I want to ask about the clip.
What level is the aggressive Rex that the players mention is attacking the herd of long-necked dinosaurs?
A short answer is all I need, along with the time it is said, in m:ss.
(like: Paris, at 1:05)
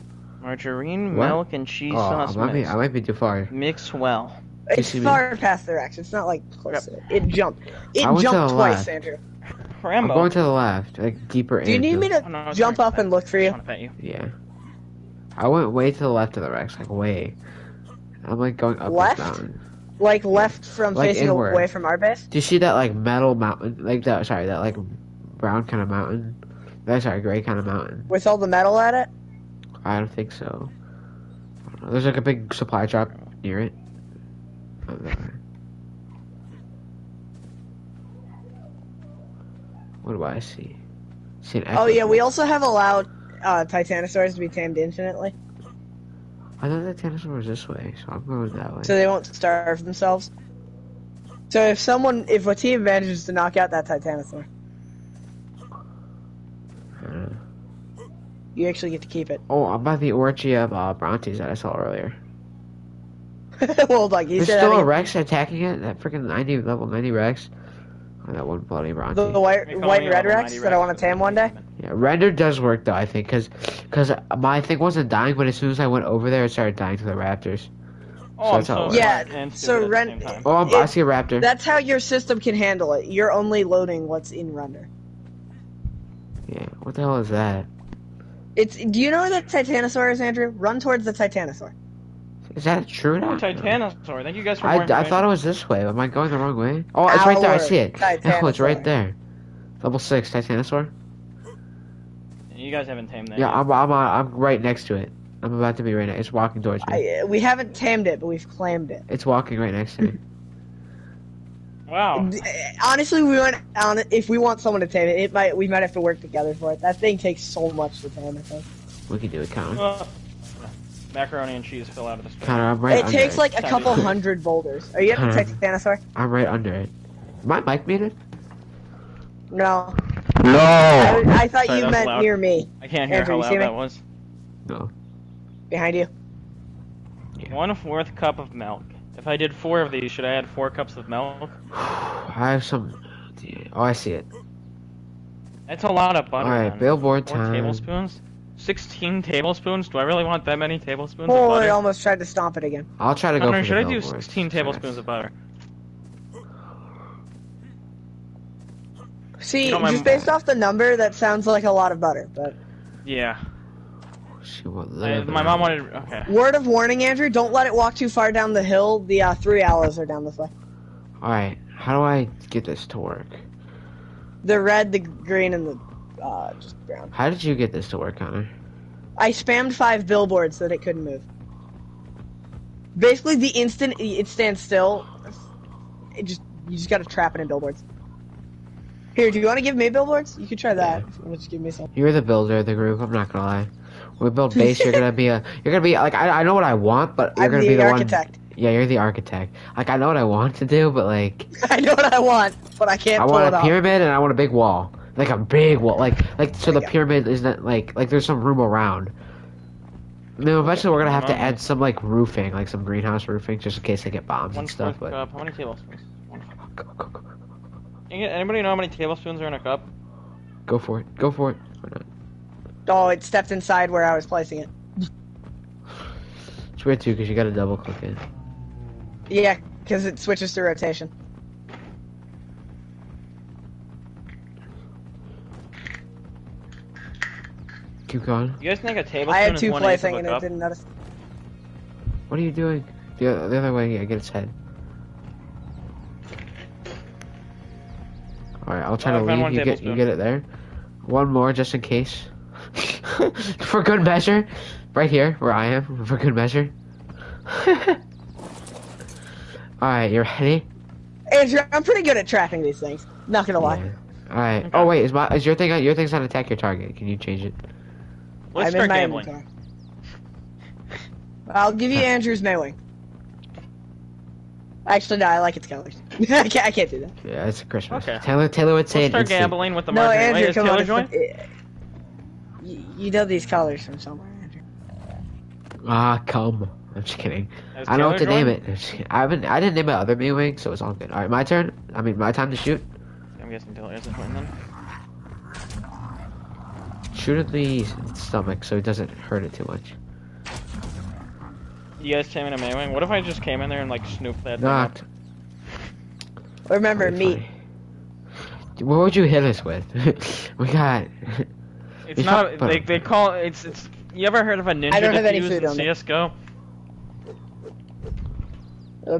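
90, at 1:06.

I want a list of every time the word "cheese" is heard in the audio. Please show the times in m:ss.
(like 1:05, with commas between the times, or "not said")
0:01, 2:01.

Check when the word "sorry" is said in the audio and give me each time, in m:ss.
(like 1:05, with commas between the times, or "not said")
0:24, 2:11.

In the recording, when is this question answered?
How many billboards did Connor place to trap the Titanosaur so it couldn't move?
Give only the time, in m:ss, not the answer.
2:59.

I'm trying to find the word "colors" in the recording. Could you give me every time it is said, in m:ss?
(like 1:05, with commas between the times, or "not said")
4:35, 4:43.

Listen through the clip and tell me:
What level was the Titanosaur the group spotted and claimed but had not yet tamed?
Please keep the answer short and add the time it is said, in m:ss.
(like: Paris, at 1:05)
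6, at 1:39.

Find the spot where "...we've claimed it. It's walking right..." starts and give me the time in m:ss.
1:48.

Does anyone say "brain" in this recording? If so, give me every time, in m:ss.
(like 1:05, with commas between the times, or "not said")
not said.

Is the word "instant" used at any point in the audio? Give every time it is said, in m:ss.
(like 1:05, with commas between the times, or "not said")
3:03, 4:39.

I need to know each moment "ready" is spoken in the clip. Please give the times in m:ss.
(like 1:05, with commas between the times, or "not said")
4:20.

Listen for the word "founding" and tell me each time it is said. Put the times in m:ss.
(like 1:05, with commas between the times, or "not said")
not said.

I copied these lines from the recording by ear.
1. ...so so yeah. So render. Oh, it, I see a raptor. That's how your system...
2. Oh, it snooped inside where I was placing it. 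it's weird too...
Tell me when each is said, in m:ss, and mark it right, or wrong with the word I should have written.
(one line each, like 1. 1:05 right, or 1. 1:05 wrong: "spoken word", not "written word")
1. 1:18 right
2. 3:42 wrong: "stepped", not "snooped".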